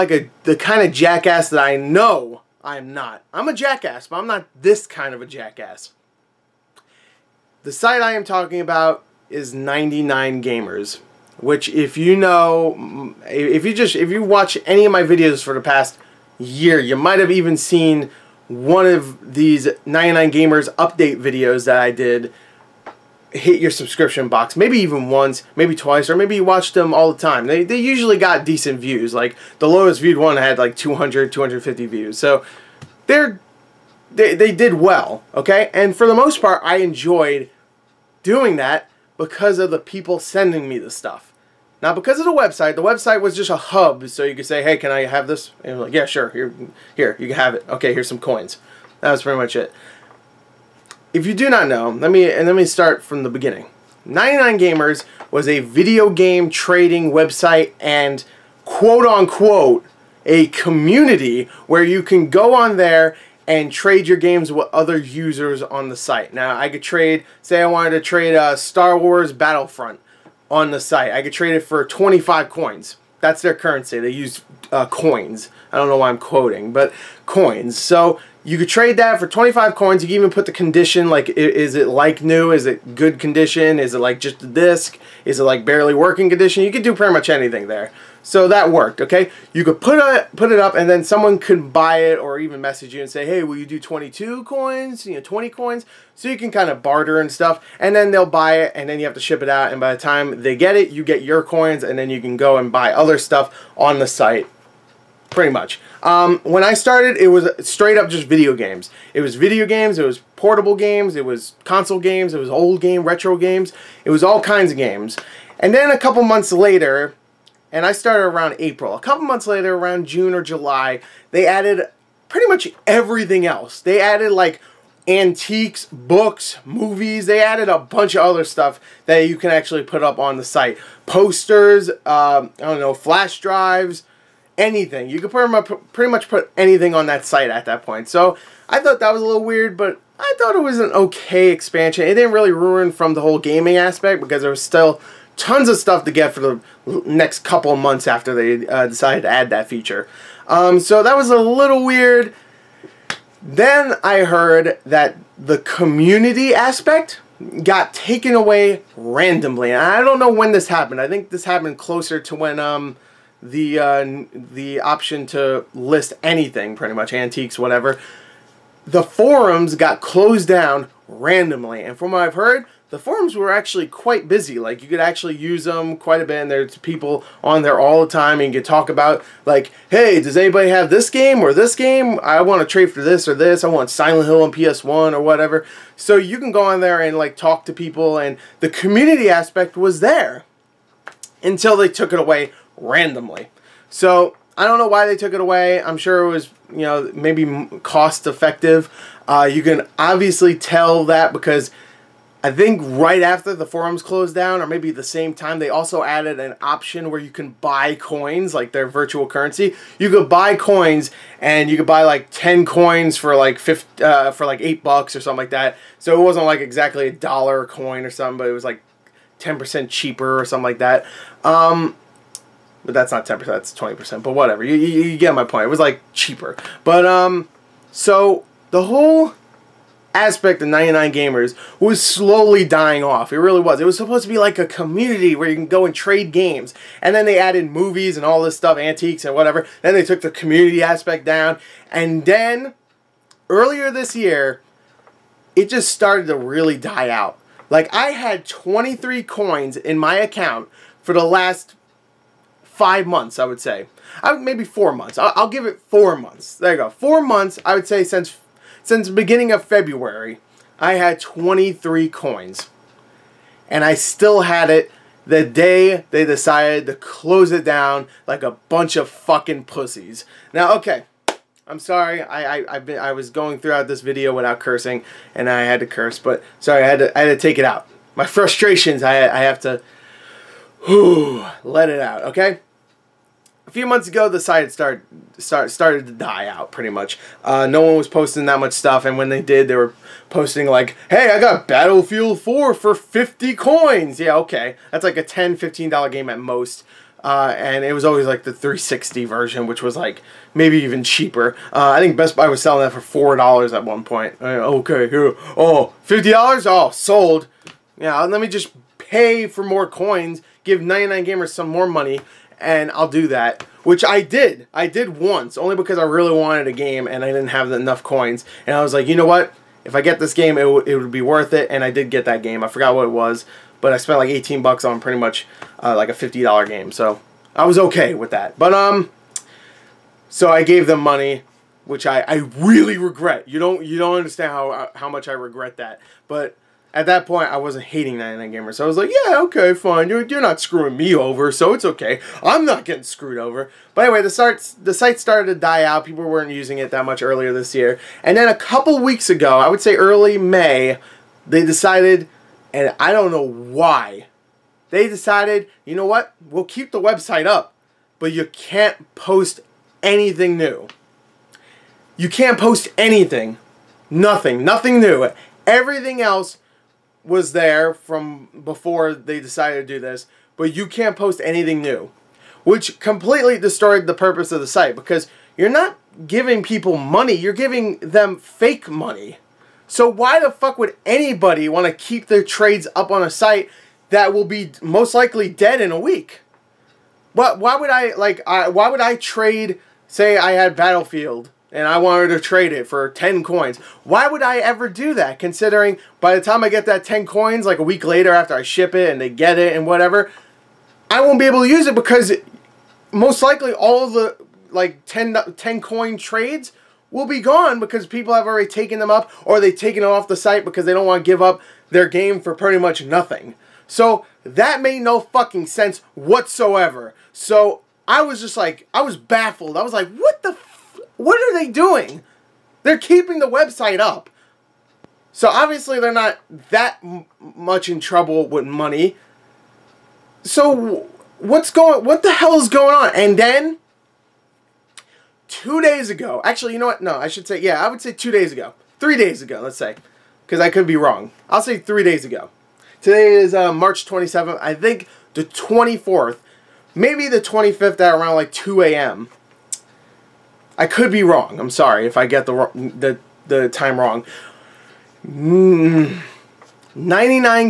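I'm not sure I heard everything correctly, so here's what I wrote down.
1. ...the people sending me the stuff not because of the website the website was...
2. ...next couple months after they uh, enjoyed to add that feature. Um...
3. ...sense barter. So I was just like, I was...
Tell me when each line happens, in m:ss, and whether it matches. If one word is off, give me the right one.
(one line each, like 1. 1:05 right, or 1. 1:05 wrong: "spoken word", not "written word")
1. 0:39 right
2. 2:27 wrong: "decided", not "enjoyed"
3. 6:55 wrong: "whatsoever", not "barter".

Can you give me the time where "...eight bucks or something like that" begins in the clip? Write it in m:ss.
3:34.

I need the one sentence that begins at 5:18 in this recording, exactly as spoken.
And I was like, you know what?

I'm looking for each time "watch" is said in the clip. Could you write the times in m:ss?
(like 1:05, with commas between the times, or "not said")
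0:14, 0:26.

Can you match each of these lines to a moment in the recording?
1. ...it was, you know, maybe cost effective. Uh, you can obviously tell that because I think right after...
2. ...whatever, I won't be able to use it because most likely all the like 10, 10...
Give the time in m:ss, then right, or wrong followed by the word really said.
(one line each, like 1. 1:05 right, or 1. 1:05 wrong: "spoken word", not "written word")
1. 3:16 right
2. 6:39 right.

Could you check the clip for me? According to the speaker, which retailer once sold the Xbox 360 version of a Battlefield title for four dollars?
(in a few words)
Best Buy.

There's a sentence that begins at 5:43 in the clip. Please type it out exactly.
But anyway, the, starts, the site started to die out.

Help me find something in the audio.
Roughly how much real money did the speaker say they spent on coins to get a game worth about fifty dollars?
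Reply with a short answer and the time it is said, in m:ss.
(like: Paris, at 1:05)
$18, at 5:24.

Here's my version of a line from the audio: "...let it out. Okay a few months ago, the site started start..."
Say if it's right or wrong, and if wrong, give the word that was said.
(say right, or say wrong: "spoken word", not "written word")
right.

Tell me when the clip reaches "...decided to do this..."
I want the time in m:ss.
6:09.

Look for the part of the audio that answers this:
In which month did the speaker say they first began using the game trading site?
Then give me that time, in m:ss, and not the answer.
1:58.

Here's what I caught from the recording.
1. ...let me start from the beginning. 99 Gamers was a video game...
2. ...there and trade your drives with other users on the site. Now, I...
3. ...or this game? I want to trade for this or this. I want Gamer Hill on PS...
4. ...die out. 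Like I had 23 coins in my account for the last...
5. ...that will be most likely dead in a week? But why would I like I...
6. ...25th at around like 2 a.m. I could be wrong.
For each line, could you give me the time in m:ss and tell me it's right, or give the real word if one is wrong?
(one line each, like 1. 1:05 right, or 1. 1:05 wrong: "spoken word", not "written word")
1. 0:52 right
2. 1:02 wrong: "games", not "drives"
3. 3:01 wrong: "Silent", not "Gamer"
4. 4:06 right
5. 6:24 right
6. 7:27 right.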